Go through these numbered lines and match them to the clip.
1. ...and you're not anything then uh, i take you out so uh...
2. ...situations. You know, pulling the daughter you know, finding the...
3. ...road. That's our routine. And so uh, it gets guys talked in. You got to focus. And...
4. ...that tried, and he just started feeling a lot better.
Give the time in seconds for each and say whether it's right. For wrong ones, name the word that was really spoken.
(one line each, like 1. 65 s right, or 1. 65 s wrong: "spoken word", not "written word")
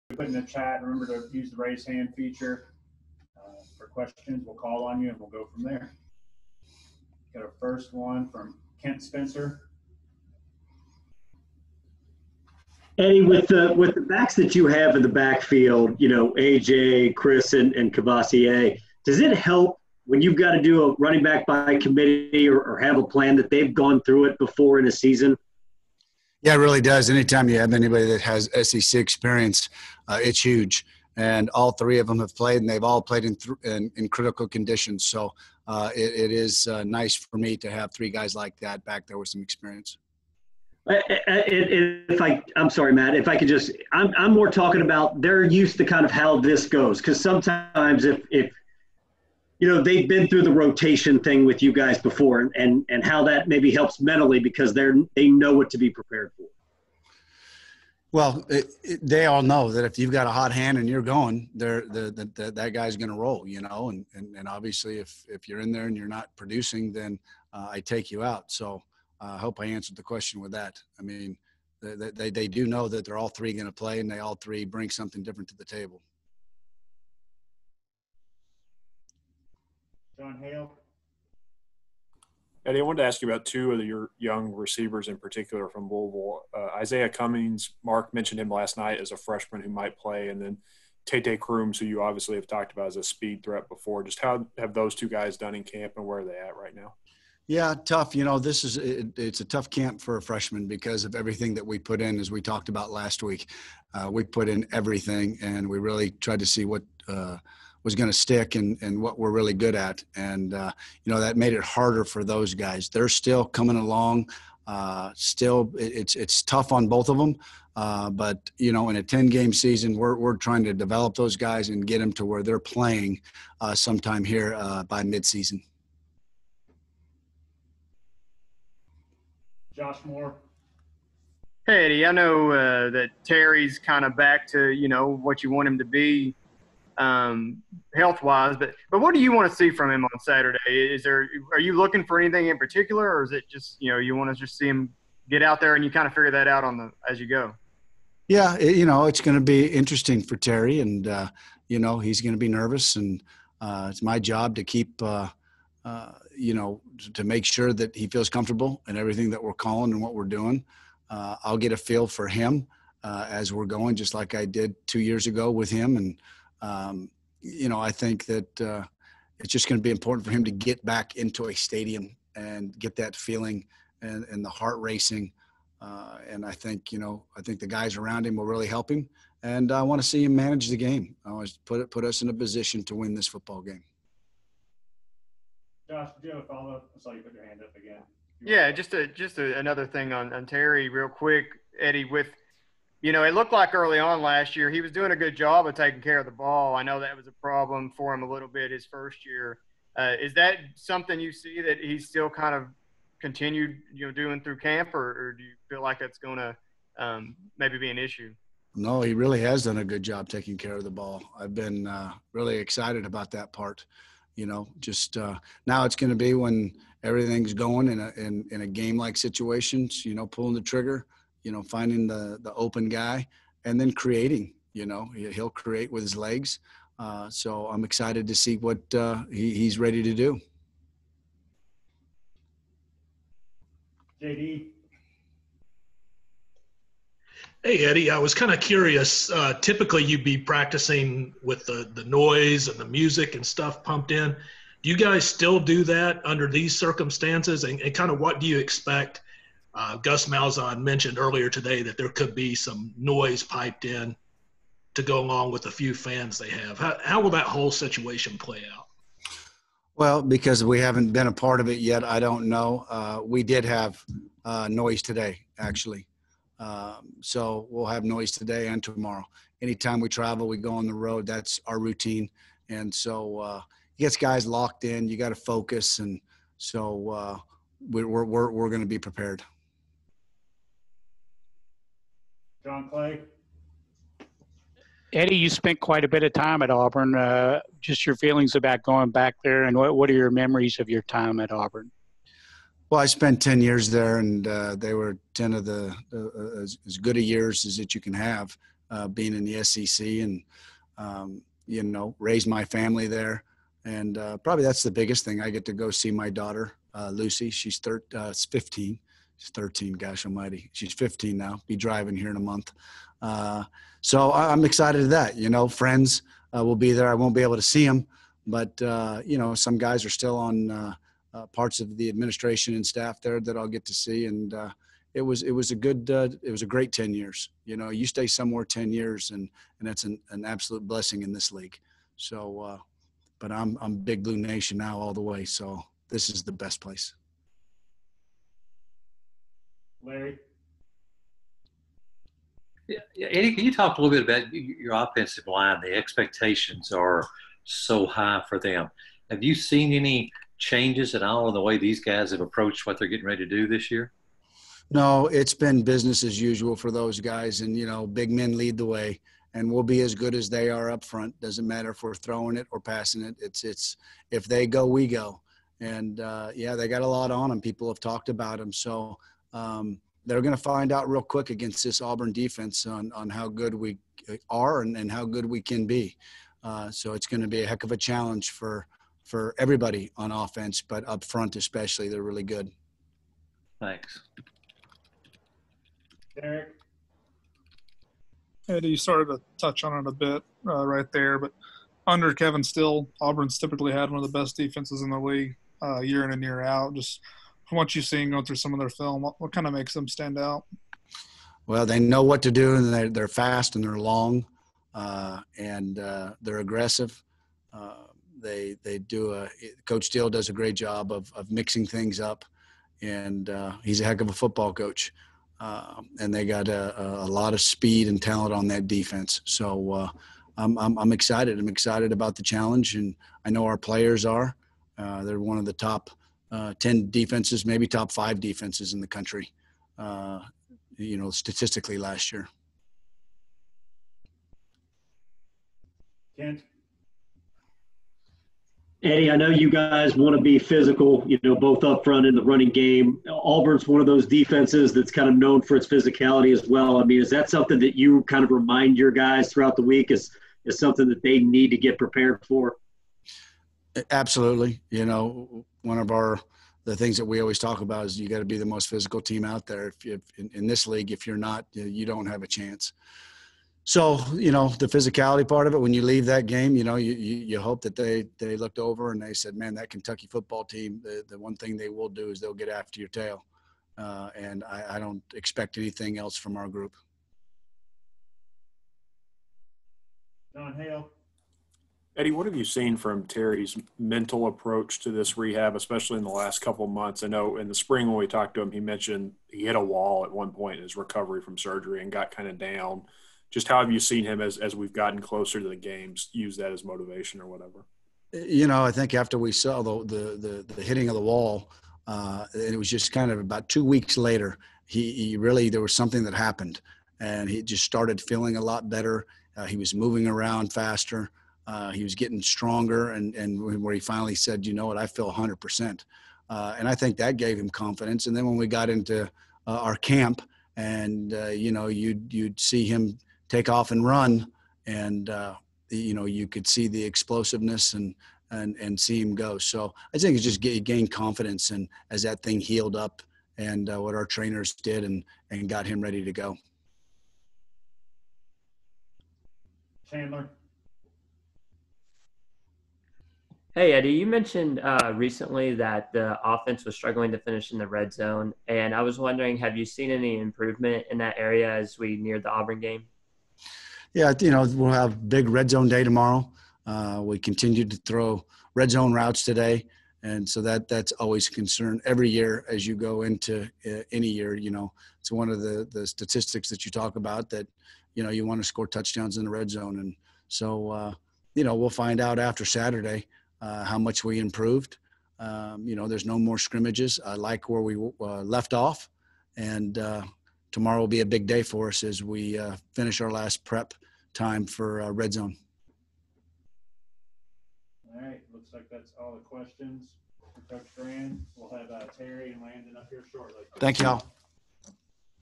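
1. 65 s wrong: "producing", not "anything"
2. 219 s wrong: "trigger", not "daughter"
3. 270 s wrong: "locked", not "talked"
4. 506 s wrong: "happened", not "tried".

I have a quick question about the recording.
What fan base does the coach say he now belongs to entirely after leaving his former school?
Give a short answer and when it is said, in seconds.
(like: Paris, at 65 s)
Big Blue Nation, at 333 s.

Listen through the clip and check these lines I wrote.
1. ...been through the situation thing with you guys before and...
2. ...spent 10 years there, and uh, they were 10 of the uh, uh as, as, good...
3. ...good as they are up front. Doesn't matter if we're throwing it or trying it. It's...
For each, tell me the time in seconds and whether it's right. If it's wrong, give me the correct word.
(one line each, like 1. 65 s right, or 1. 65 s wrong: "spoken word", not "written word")
1. 50 s wrong: "rotation", not "situation"
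2. 293 s right
3. 360 s wrong: "passing", not "trying".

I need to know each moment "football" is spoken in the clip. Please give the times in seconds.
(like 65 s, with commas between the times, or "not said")
183 s, 414 s, 470 s.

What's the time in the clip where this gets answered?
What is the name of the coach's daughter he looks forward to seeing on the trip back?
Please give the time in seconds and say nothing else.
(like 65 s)
307 s.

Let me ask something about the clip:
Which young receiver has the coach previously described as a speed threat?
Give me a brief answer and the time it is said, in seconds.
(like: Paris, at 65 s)
Tate Crooms, at 91 s.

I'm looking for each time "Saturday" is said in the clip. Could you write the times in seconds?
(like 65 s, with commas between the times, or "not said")
140 s, 572 s.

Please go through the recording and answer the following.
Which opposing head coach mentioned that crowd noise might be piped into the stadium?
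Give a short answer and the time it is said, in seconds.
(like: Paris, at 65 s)
Gus Malzahn, at 249 s.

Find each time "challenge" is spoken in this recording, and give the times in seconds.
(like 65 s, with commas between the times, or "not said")
377 s, 422 s.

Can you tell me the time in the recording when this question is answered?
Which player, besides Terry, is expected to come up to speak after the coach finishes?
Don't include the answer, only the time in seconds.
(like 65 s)
592 s.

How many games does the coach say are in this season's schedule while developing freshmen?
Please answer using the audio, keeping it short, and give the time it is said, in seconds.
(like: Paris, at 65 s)
10, at 119 s.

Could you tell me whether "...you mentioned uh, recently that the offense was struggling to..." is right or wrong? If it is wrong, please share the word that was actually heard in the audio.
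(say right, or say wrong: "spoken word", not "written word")
right.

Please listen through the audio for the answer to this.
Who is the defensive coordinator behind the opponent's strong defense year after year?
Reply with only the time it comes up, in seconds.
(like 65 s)
392 s.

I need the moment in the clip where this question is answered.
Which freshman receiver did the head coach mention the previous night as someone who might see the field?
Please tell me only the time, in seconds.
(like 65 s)
86 s.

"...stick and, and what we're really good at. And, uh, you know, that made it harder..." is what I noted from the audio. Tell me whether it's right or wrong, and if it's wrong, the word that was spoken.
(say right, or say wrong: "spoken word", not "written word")
right.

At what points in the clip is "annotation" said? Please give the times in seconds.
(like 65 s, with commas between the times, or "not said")
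not said.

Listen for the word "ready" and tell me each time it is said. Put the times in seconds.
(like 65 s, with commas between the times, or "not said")
229 s, 353 s, 536 s.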